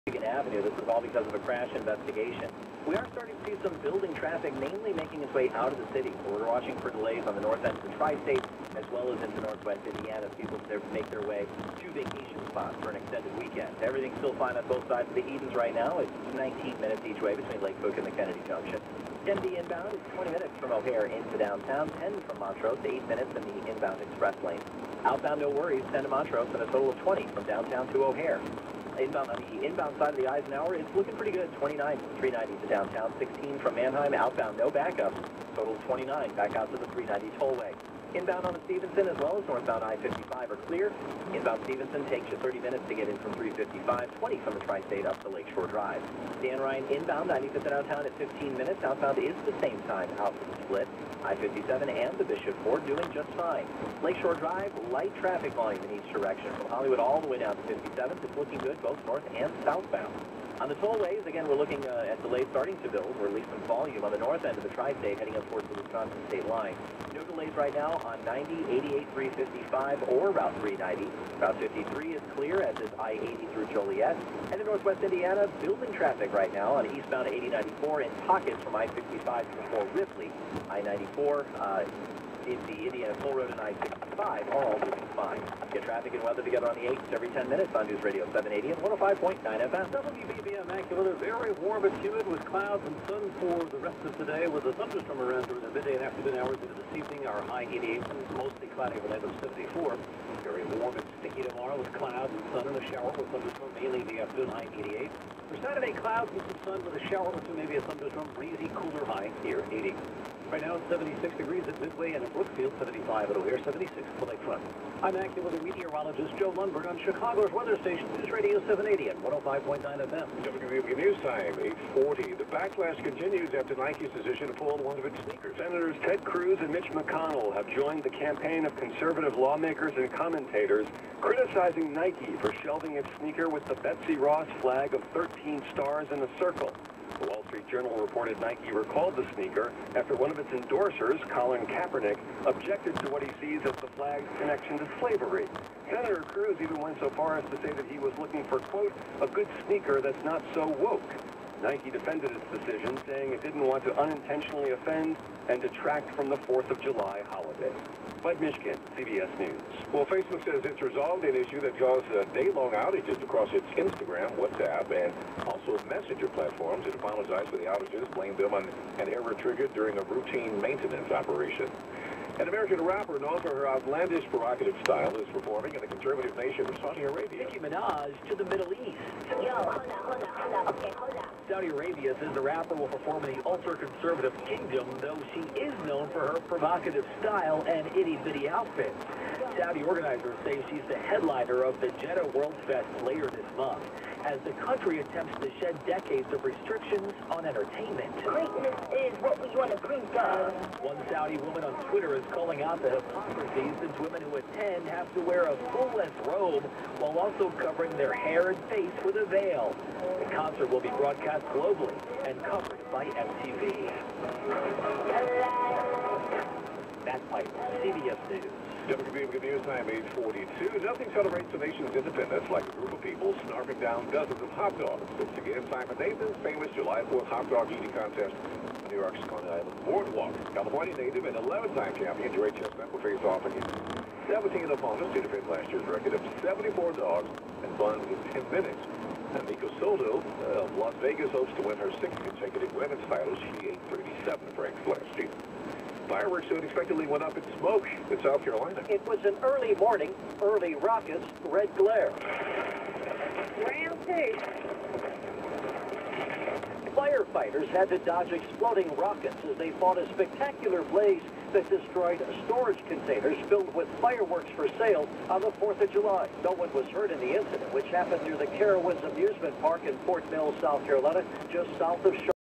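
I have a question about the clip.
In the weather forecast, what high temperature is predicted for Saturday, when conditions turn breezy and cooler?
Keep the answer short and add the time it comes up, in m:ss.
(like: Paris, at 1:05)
80, at 1:49.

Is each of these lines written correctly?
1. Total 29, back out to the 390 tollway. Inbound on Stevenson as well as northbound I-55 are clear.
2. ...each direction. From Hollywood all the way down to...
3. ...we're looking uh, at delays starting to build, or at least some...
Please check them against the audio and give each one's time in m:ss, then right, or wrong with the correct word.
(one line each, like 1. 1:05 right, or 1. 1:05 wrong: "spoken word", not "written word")
1. 0:35 right
2. 0:56 right
3. 1:01 right.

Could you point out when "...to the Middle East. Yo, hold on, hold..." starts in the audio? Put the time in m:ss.
2:58.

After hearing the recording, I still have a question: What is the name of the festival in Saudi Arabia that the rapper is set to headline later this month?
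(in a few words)
Jeddah World Fest.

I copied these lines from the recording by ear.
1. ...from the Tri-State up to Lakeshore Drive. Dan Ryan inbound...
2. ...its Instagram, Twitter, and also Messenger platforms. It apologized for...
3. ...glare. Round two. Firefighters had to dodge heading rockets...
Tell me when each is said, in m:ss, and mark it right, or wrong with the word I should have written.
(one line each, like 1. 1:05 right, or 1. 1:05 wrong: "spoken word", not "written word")
1. 0:44 right
2. 2:43 wrong: "WhatsApp", not "Twitter"
3. 4:11 wrong: "exploding", not "heading".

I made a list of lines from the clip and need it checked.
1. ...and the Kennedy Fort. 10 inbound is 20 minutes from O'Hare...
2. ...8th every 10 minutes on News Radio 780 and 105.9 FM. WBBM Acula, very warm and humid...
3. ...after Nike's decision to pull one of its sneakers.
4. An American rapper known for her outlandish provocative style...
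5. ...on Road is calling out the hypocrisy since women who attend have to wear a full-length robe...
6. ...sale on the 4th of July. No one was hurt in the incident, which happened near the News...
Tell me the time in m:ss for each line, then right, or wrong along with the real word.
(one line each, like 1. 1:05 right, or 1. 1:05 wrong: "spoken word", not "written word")
1. 0:17 wrong: "Junction", not "Fort"
2. 1:26 right
3. 2:03 right
4. 2:52 right
5. 3:21 wrong: "Twitter", not "Road"
6. 4:24 wrong: "Carowinds", not "News".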